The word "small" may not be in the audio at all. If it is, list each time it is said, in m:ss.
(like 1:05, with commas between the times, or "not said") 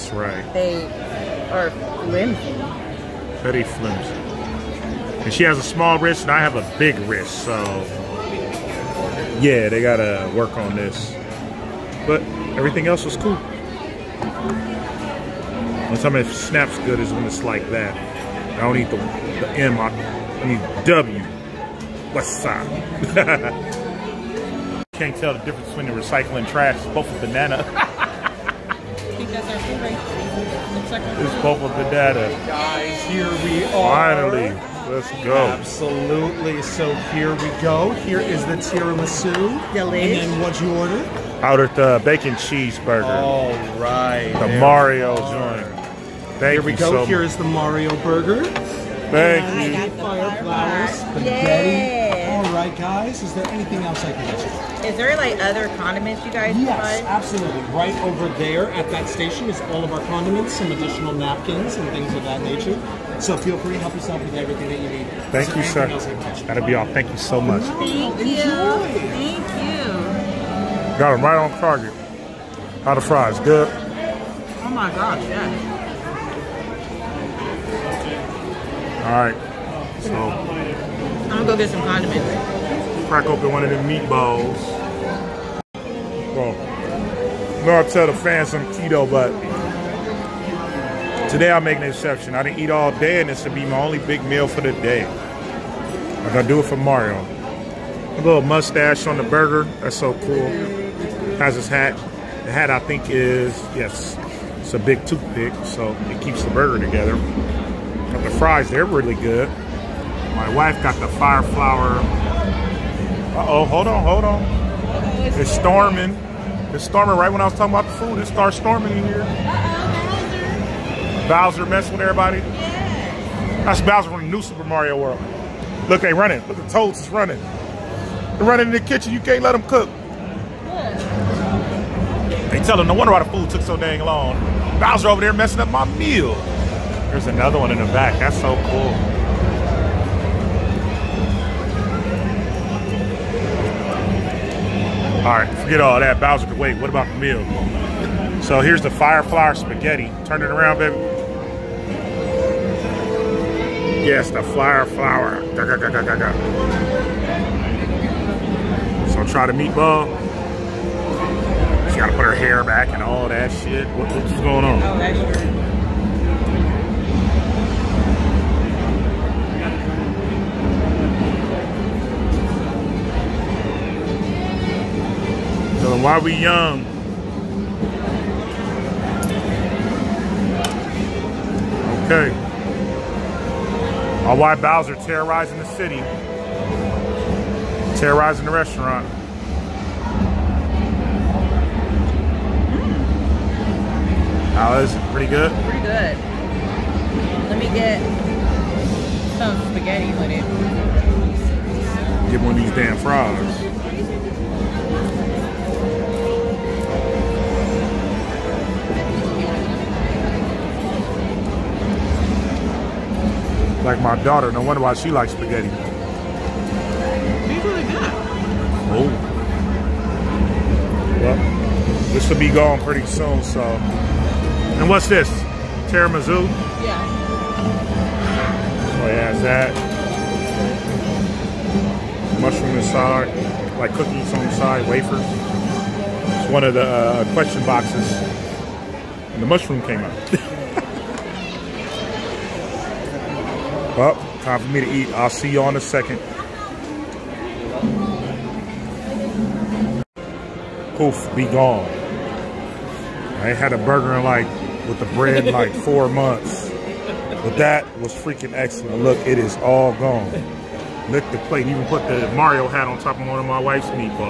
0:05.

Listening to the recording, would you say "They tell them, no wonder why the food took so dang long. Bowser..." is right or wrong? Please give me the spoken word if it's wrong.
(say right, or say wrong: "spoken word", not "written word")
right.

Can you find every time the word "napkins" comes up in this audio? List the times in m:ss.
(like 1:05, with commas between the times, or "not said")
1:01.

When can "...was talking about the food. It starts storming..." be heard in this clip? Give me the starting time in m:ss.
1:57.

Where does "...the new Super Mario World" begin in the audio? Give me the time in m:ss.
2:04.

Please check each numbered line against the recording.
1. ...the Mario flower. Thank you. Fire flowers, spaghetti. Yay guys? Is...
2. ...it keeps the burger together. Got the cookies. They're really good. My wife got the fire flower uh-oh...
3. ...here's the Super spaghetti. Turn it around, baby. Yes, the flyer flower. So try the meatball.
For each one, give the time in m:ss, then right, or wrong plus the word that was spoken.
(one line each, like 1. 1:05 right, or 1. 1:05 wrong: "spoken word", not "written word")
1. 0:47 wrong: "burger", not "flower"
2. 1:46 wrong: "fries", not "cookies"
3. 2:28 wrong: "Firefly", not "Super".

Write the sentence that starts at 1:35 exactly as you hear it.
I'm gonna do it for Mario.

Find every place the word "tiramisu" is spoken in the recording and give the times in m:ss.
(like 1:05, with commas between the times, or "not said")
0:38, 3:45.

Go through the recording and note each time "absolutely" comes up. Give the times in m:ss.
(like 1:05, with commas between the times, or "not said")
0:35, 0:57.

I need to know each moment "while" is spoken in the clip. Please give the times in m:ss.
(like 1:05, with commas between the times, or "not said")
2:56.